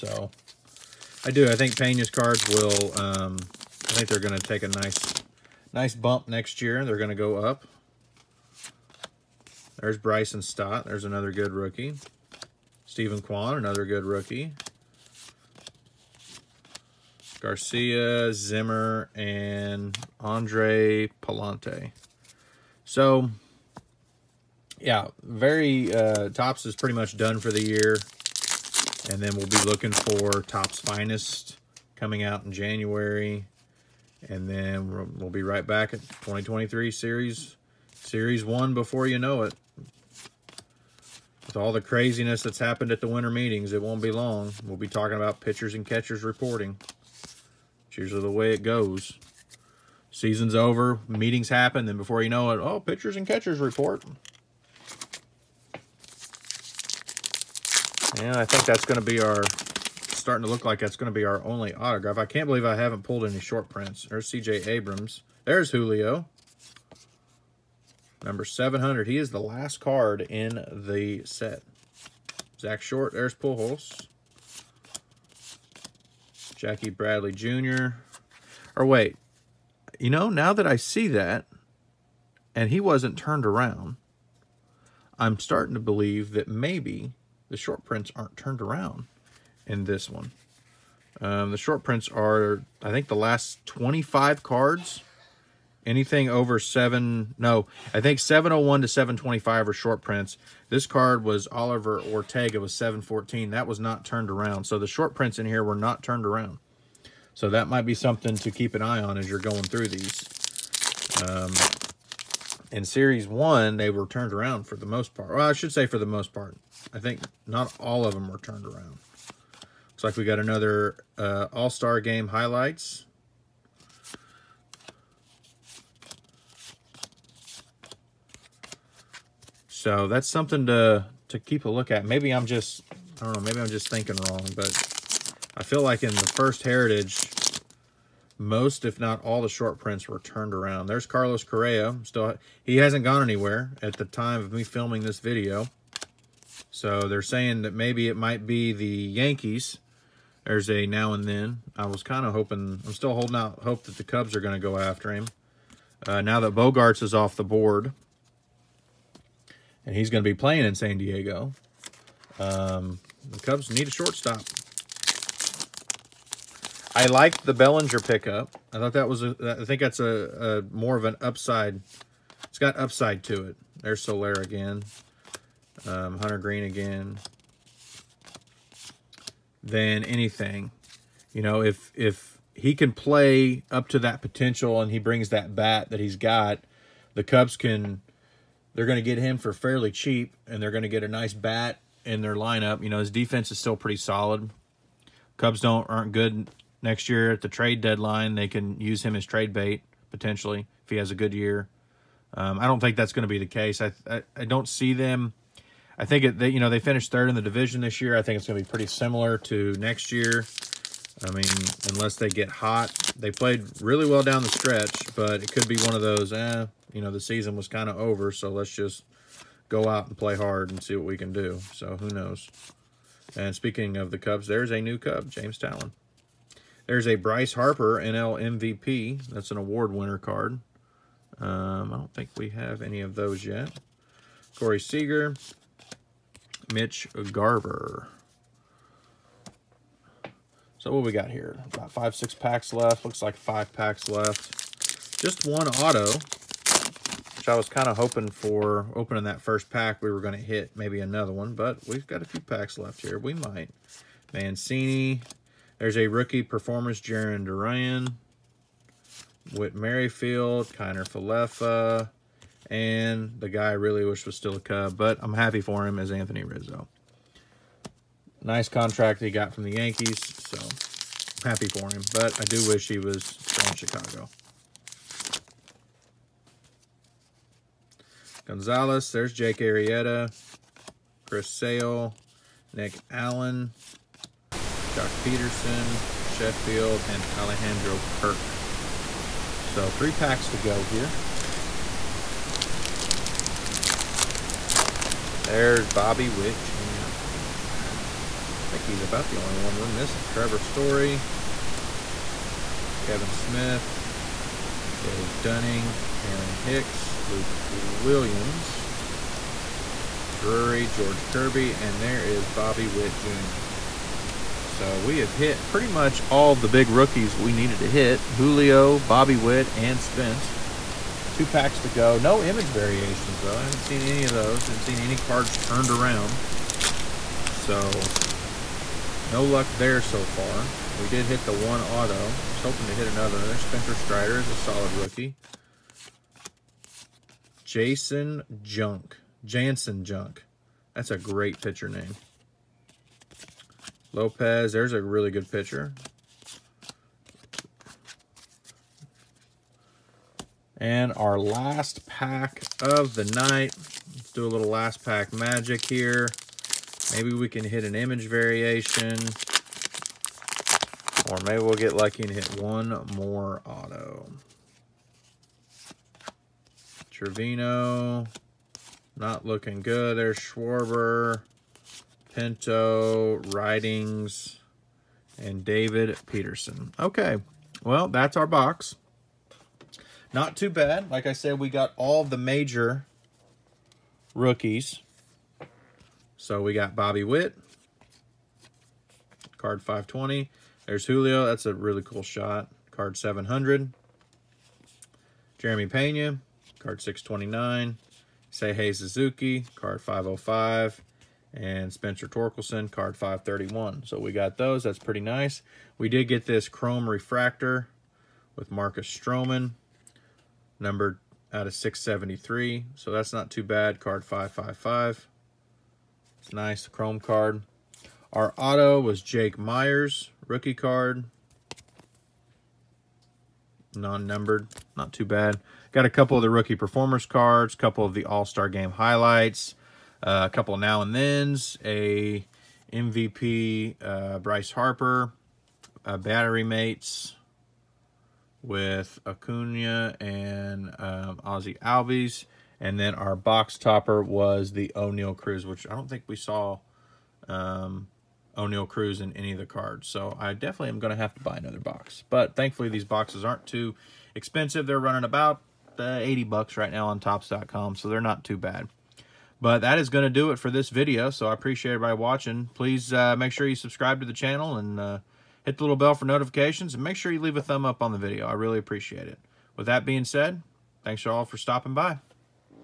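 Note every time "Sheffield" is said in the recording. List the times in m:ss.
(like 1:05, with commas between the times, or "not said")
4:46.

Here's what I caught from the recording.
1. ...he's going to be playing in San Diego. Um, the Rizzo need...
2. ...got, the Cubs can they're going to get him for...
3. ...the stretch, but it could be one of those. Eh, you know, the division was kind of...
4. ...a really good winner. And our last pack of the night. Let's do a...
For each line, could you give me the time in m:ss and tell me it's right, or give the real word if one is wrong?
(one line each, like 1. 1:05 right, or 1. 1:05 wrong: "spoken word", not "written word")
1. 2:39 wrong: "Cubs", not "Rizzo"
2. 3:06 right
3. 3:34 wrong: "season", not "division"
4. 5:44 wrong: "pitcher", not "winner".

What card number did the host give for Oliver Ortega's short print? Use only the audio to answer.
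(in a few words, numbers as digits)
714.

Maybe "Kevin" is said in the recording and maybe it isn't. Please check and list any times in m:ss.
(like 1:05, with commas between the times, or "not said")
5:03.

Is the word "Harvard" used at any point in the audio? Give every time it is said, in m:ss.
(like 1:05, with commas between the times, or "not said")
not said.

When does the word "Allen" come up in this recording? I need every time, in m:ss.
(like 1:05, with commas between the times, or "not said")
4:43.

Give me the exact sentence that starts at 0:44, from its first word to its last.
We'll be talking about pitchers and catchers reporting.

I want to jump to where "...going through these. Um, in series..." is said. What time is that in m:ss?
1:49.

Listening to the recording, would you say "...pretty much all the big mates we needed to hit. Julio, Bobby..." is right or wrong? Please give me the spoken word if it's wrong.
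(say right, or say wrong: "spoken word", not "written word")
wrong: "rookies", not "mates".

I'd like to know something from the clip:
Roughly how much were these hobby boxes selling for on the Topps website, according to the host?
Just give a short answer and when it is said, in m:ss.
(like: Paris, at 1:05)
$80, at 7:36.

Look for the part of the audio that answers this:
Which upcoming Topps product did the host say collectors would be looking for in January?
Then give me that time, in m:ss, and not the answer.
0:30.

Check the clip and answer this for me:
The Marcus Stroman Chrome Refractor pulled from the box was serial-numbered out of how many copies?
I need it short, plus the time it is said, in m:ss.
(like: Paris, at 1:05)
673, at 6:51.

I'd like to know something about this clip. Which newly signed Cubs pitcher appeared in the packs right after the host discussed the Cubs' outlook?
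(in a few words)
Jameson Taillon.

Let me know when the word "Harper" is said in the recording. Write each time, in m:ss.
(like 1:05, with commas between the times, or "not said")
3:47, 7:14.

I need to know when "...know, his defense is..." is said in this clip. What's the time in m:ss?
3:12.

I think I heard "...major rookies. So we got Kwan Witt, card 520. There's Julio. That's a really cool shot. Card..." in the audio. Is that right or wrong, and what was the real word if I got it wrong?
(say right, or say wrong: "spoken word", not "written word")
wrong: "Bobby", not "Kwan".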